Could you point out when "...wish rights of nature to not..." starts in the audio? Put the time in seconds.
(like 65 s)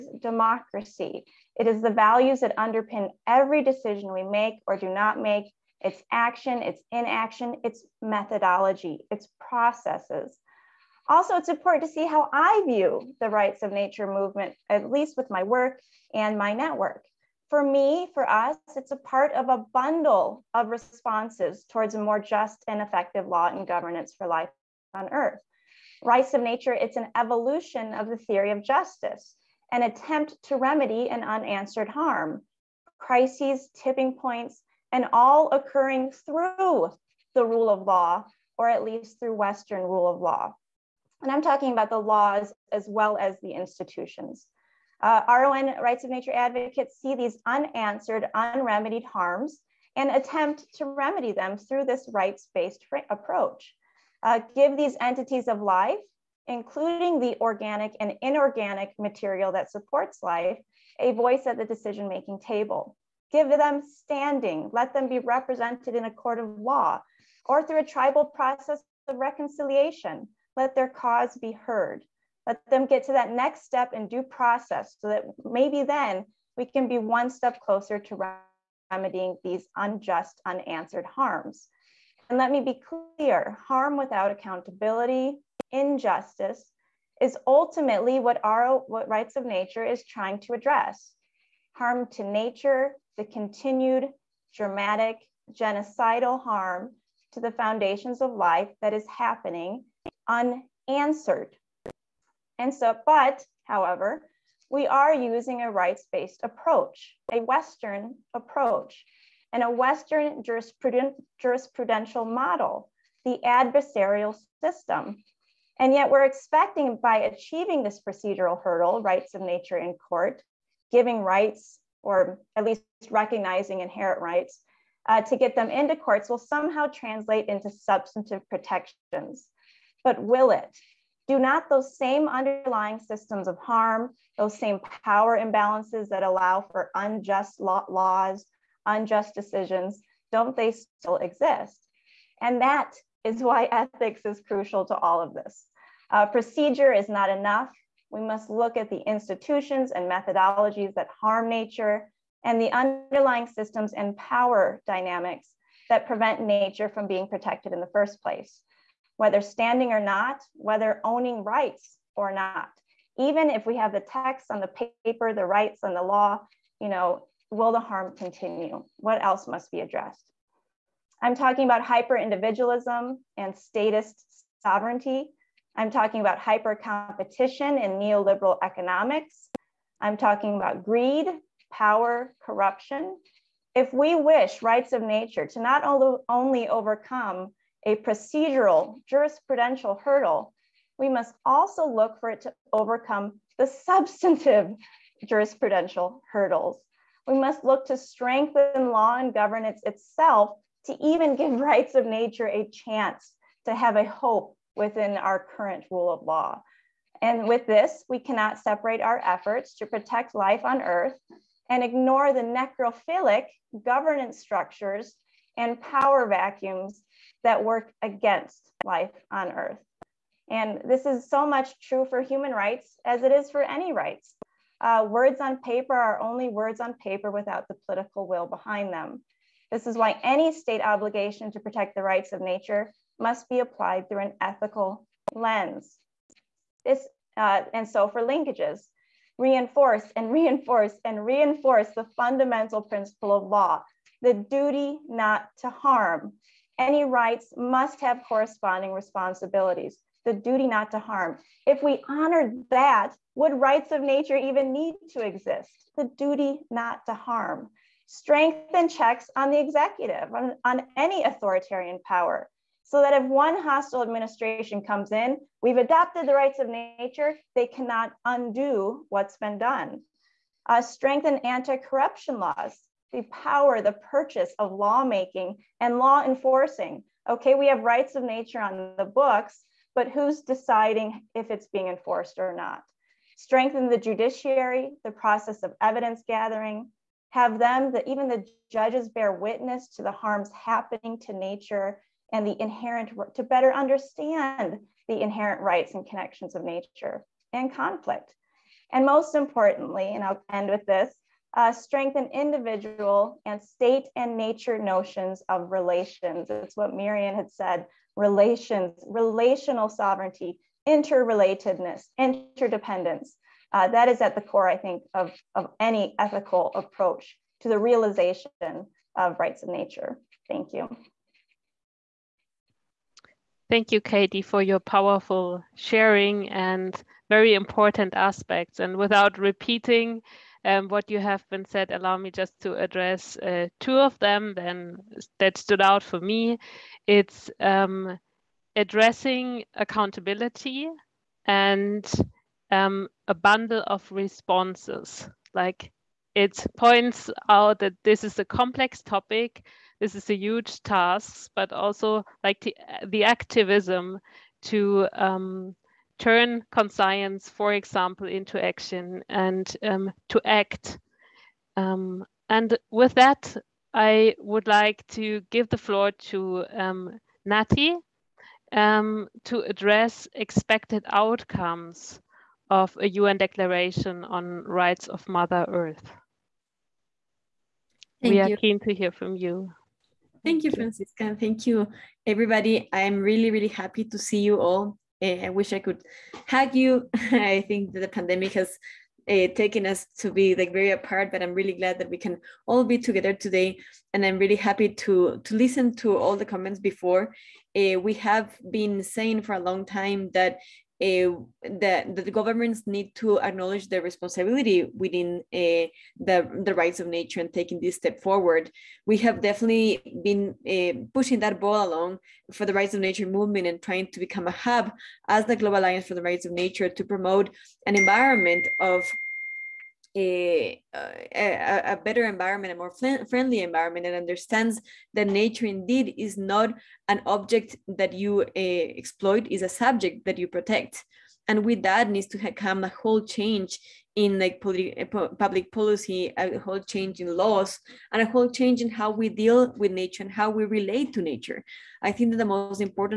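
184 s.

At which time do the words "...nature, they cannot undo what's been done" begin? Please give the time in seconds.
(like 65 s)
266 s.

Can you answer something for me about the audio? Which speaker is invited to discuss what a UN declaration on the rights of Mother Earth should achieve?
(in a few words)
Nati.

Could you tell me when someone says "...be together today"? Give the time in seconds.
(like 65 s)
392 s.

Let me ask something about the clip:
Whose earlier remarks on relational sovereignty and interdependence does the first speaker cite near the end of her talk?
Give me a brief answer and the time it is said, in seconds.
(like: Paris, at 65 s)
Mirian, at 306 s.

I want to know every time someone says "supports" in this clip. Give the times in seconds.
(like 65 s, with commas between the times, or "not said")
59 s.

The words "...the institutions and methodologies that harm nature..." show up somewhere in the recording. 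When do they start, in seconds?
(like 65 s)
148 s.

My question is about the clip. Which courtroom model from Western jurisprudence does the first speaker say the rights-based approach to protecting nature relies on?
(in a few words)
the adversarial system.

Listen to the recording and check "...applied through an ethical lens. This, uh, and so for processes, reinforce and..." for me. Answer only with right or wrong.
wrong.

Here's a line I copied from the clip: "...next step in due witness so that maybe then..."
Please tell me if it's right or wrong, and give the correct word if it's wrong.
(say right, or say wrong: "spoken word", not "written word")
wrong: "process", not "witness".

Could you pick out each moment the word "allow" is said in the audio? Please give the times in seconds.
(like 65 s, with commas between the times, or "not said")
136 s, 331 s.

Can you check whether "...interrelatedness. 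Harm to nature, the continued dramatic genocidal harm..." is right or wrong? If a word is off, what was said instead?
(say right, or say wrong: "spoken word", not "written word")
wrong: "address", not "interrelatedness".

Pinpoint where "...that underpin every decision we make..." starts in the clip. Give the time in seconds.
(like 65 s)
2 s.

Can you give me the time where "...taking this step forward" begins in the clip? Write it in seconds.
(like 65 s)
407 s.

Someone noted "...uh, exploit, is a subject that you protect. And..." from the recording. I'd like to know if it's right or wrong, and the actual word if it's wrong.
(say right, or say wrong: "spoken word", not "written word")
right.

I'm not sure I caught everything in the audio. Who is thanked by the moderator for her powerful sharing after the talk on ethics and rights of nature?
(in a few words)
Katie.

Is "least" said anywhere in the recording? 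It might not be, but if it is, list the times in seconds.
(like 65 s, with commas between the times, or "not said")
14 s, 38 s, 122 s.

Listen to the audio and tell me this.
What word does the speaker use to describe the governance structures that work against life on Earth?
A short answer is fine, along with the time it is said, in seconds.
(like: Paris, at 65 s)
necrophilic, at 212 s.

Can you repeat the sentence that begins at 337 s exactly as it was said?
It's um, addressing accountability and um, a bundle of responses.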